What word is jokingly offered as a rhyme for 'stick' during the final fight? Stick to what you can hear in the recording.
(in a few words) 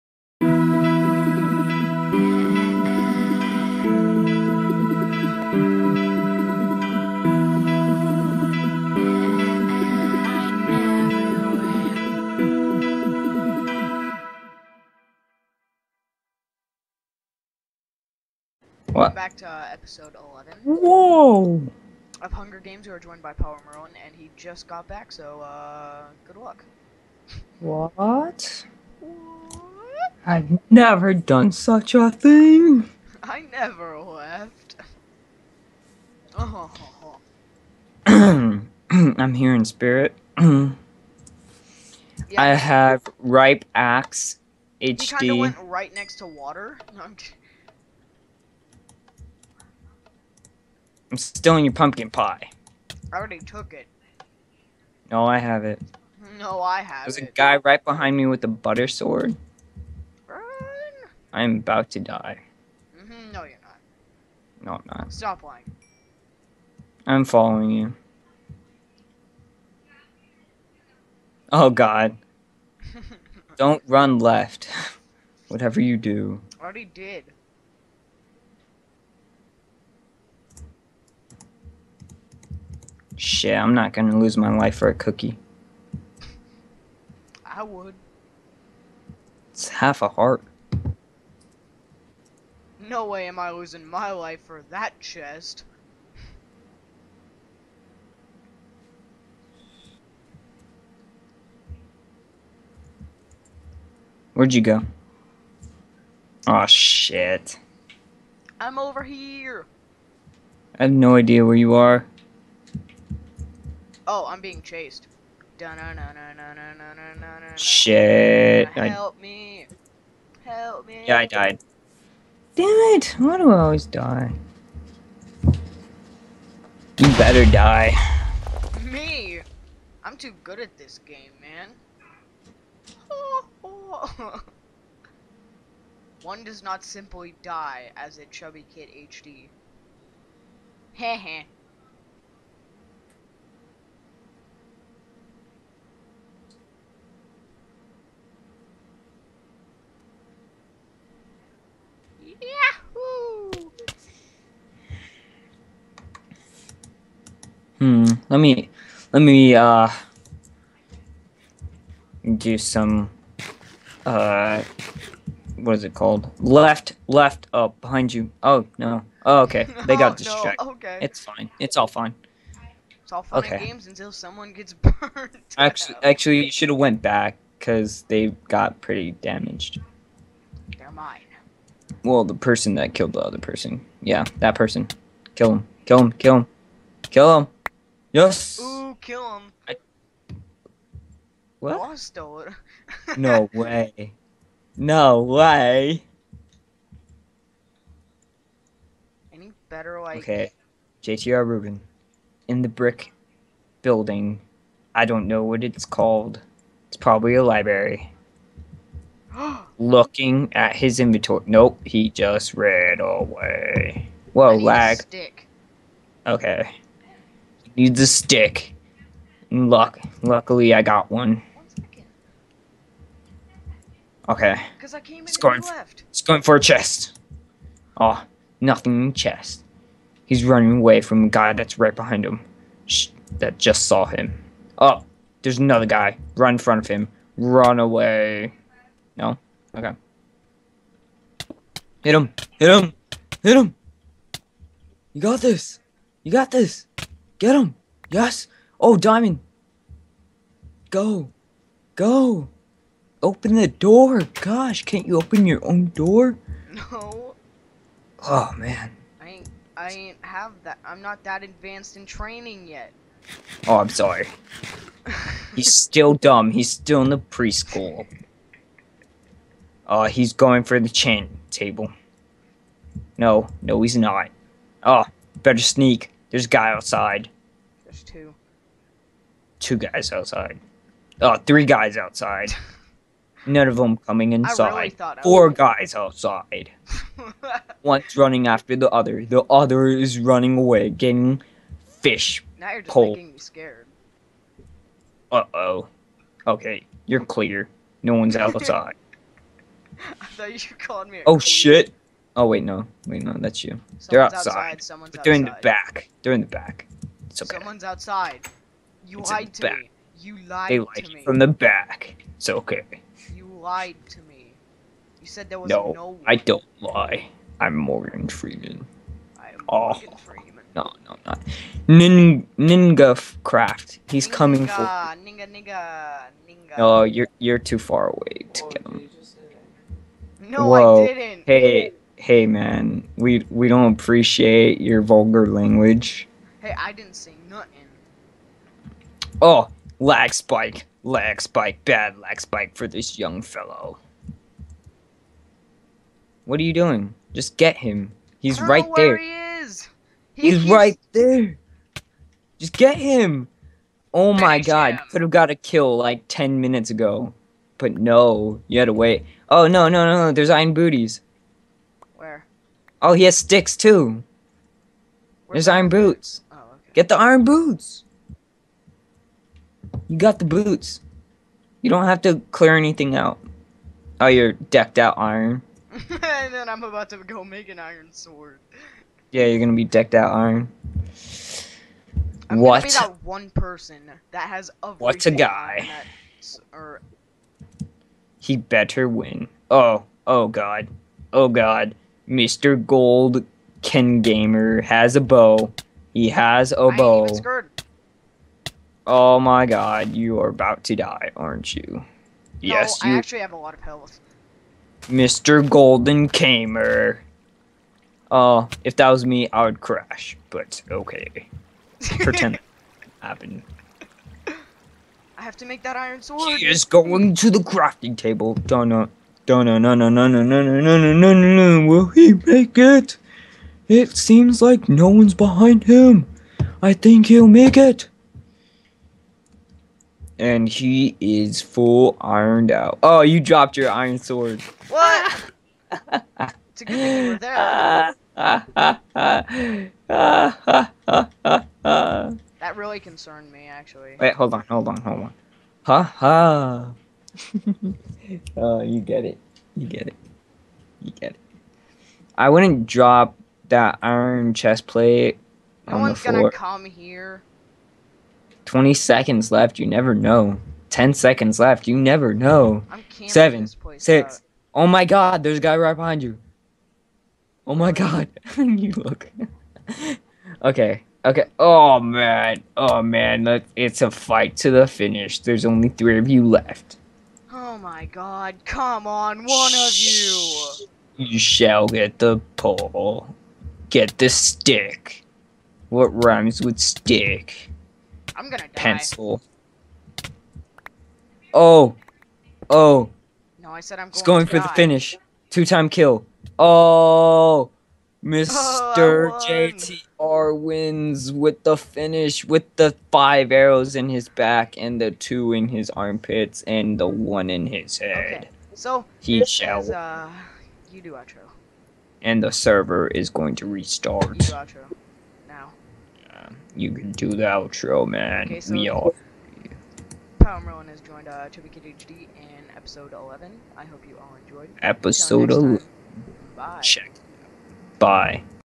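Pencil.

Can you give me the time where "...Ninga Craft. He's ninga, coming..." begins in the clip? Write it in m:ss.
5:22.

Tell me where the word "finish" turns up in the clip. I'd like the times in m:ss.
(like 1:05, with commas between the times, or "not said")
7:54, 8:14, 8:21.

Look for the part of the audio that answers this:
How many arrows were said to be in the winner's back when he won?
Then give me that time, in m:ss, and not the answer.
8:23.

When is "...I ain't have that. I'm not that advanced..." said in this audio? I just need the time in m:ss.
4:19.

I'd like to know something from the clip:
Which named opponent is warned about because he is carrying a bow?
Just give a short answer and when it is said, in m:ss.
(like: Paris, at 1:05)
Mr. Gold Ken Gamer, at 6:32.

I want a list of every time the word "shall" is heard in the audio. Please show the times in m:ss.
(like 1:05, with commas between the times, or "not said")
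8:01, 8:29.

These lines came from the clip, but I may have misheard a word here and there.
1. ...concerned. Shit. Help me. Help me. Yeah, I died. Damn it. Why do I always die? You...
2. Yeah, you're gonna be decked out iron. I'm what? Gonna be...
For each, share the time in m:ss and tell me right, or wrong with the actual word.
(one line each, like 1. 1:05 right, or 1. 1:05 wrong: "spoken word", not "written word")
1. 1:54 wrong: "chased", not "concerned"
2. 6:19 right.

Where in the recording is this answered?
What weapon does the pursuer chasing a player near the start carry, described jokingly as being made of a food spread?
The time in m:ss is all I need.
0:58.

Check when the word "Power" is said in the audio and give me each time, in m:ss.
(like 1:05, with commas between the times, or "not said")
0:23, 8:40.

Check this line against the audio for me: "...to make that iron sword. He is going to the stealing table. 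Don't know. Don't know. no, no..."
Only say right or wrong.
wrong.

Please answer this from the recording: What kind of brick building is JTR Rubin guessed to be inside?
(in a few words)
library.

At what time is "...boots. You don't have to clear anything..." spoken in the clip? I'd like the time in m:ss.
6:10.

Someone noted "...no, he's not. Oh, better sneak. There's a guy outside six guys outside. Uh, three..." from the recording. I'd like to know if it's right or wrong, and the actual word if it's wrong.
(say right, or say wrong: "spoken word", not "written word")
wrong: "two", not "six".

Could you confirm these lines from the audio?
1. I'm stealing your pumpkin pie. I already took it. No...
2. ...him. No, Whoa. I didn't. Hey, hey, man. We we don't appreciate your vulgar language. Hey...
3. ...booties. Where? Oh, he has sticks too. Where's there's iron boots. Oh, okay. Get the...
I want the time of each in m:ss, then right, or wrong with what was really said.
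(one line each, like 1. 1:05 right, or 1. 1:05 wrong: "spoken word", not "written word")
1. 0:51 right
2. 5:28 right
3. 6:00 right.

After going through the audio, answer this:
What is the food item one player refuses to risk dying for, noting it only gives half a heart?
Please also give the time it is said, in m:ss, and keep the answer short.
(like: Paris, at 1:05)
cookie, at 1:24.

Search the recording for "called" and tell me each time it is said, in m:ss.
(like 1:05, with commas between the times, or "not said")
2:45, 3:25, 5:00.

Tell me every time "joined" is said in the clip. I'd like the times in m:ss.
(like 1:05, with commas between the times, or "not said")
0:22, 8:41.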